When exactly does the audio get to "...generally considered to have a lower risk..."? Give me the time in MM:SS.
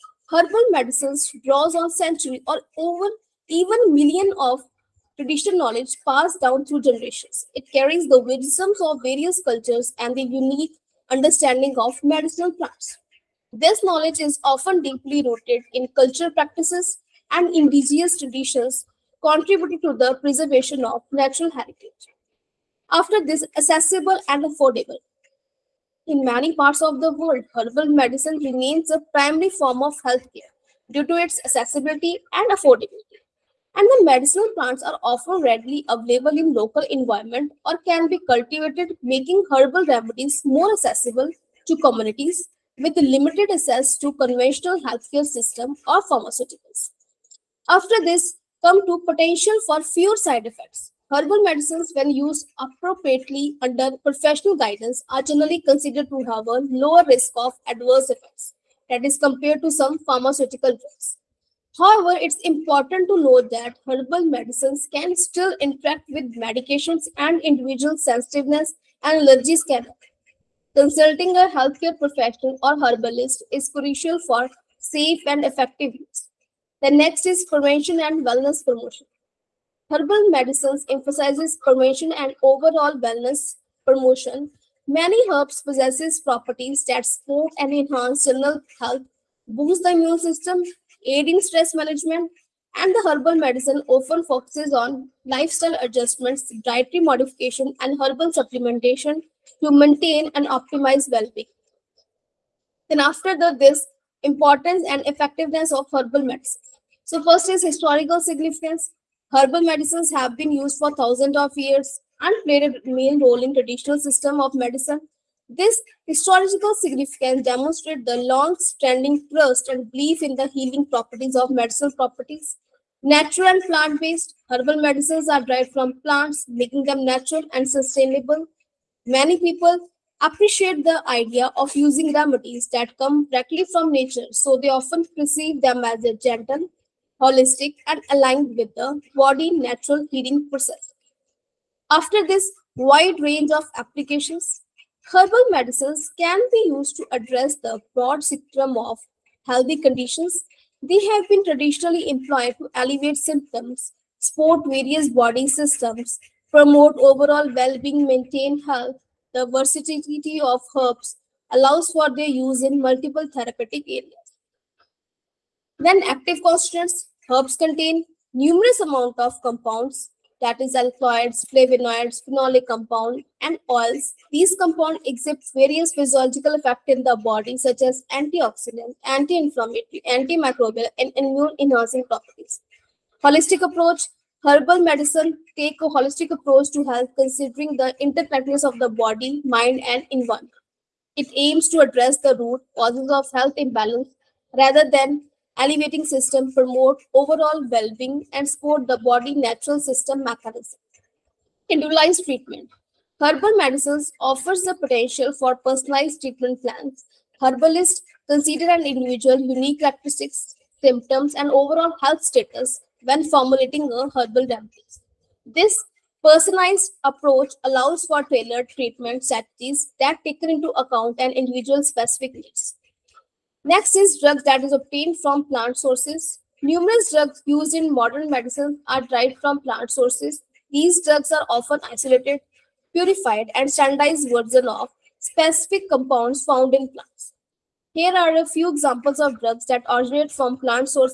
00:55.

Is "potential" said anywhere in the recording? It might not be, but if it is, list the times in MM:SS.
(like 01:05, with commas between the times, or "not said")
00:49, 03:24.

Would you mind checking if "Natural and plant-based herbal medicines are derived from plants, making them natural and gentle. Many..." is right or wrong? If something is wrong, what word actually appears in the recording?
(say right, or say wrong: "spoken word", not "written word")
wrong: "sustainable", not "gentle".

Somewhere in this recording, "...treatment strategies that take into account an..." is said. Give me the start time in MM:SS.
03:38.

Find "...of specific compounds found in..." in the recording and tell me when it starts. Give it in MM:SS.
03:54.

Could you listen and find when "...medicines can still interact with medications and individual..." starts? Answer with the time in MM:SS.
01:04.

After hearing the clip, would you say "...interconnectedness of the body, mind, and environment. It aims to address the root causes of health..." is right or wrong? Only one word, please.
right.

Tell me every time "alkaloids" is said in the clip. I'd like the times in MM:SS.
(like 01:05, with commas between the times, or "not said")
02:50.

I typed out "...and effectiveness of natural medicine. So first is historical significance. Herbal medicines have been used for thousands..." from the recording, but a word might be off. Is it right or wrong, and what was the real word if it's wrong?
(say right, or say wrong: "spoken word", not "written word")
wrong: "herbal", not "natural".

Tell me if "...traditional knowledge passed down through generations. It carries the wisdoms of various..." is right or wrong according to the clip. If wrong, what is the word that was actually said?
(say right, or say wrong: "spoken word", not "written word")
right.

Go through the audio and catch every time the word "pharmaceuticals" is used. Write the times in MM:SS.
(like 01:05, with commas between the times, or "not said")
00:46, 00:59.